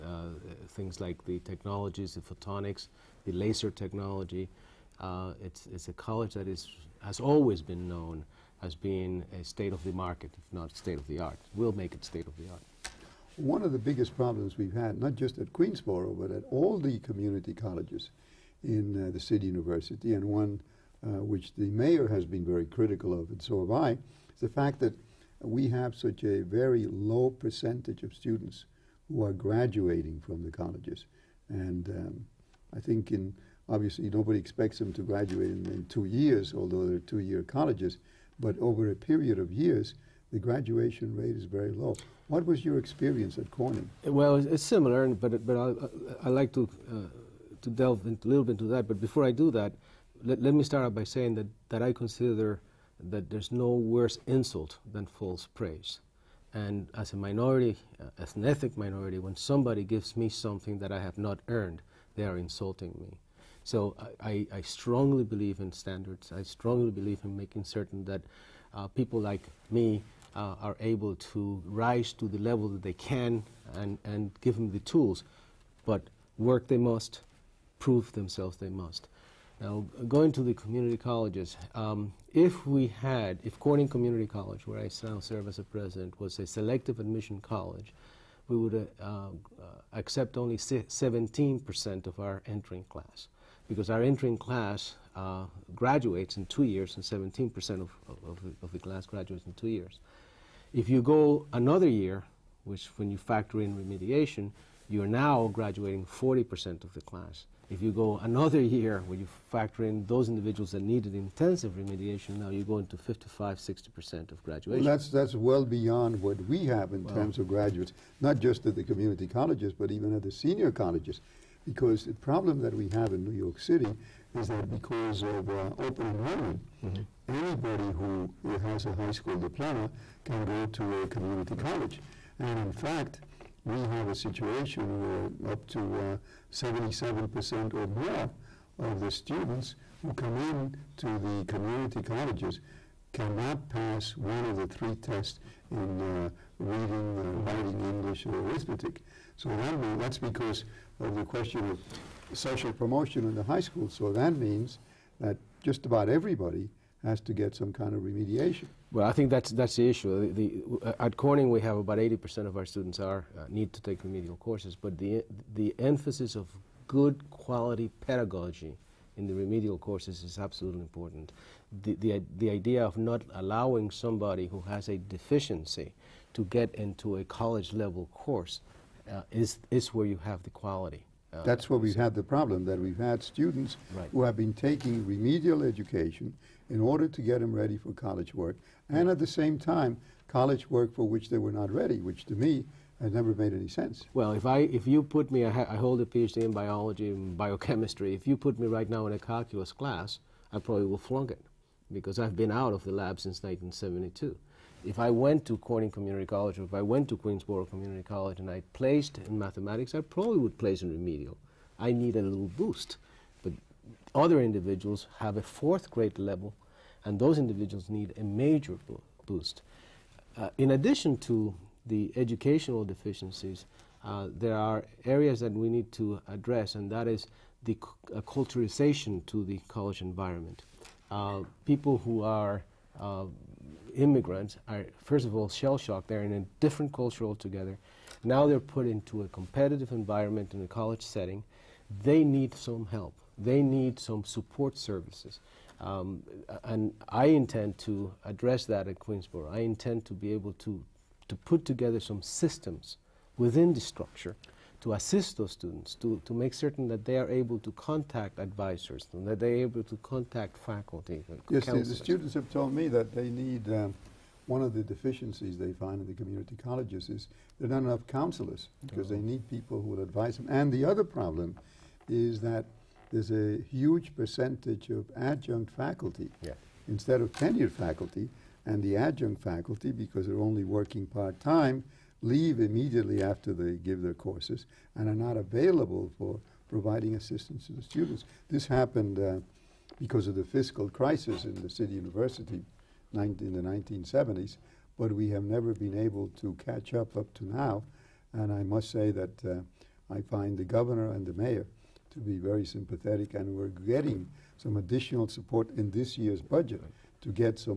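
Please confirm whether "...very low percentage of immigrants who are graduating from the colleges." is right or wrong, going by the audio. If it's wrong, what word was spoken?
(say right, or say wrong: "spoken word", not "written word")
wrong: "students", not "immigrants".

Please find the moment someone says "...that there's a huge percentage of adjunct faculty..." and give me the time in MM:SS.
04:32.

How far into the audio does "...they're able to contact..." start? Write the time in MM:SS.
04:19.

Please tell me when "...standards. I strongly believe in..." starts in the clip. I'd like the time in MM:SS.
01:05.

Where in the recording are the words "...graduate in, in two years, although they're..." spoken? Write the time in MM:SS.
00:35.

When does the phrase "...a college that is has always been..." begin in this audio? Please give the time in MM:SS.
00:05.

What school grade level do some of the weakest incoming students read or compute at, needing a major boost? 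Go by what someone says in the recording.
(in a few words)
fourth grade.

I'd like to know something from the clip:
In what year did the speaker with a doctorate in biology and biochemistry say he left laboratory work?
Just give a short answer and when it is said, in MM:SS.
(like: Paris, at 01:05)
1972, at 03:23.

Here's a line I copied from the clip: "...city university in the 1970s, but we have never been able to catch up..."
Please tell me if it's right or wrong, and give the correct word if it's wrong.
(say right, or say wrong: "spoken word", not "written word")
right.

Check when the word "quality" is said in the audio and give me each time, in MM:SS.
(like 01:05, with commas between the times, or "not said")
02:47, 03:00.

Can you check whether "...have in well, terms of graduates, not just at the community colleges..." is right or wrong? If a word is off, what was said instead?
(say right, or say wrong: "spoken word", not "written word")
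right.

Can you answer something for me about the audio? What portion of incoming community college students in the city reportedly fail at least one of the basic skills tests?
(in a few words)
77%.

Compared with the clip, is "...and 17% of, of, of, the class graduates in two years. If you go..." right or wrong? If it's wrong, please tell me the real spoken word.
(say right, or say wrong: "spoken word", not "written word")
right.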